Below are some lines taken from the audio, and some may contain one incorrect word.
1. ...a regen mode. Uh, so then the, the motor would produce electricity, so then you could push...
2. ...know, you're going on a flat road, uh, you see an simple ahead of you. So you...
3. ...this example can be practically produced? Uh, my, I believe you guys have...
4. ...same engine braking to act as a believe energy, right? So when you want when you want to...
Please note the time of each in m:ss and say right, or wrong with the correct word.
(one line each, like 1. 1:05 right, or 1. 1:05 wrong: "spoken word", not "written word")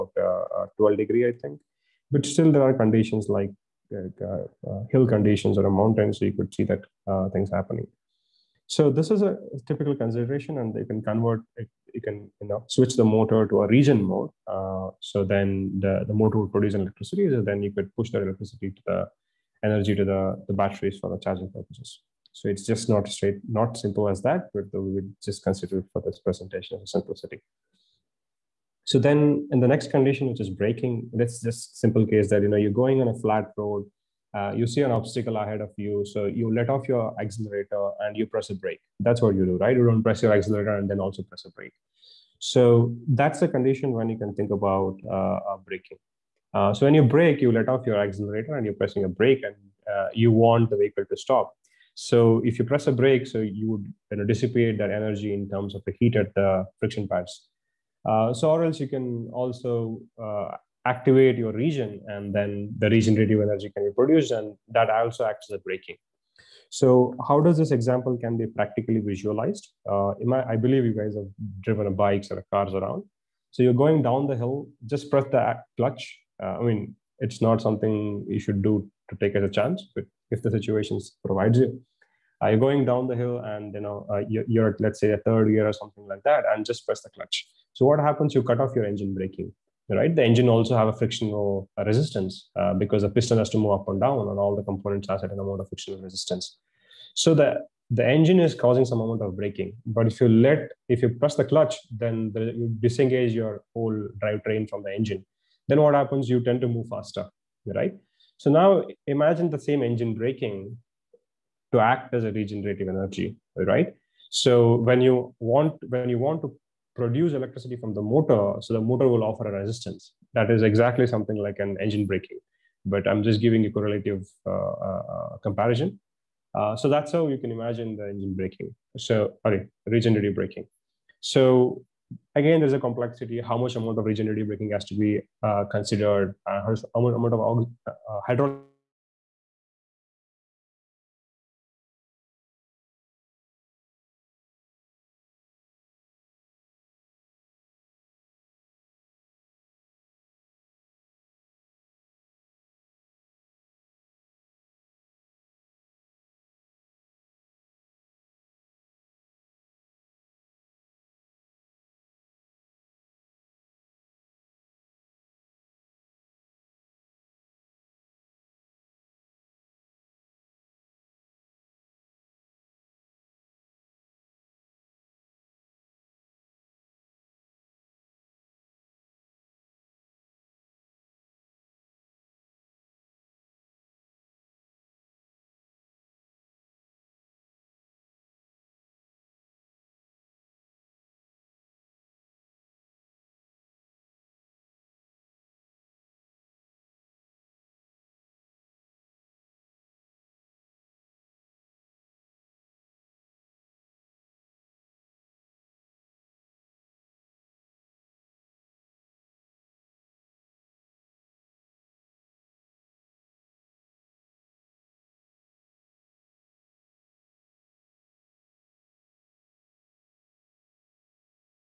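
1. 0:13 right
2. 0:32 wrong: "obstacle", not "simple"
3. 1:07 wrong: "visualized", not "produced"
4. 1:49 wrong: "regenerative", not "believe".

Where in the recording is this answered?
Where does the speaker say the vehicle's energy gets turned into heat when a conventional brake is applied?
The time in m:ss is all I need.
0:56.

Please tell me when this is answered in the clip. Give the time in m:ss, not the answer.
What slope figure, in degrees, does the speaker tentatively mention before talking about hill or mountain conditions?
0:00.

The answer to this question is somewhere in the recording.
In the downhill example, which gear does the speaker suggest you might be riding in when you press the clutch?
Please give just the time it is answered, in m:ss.
1:25.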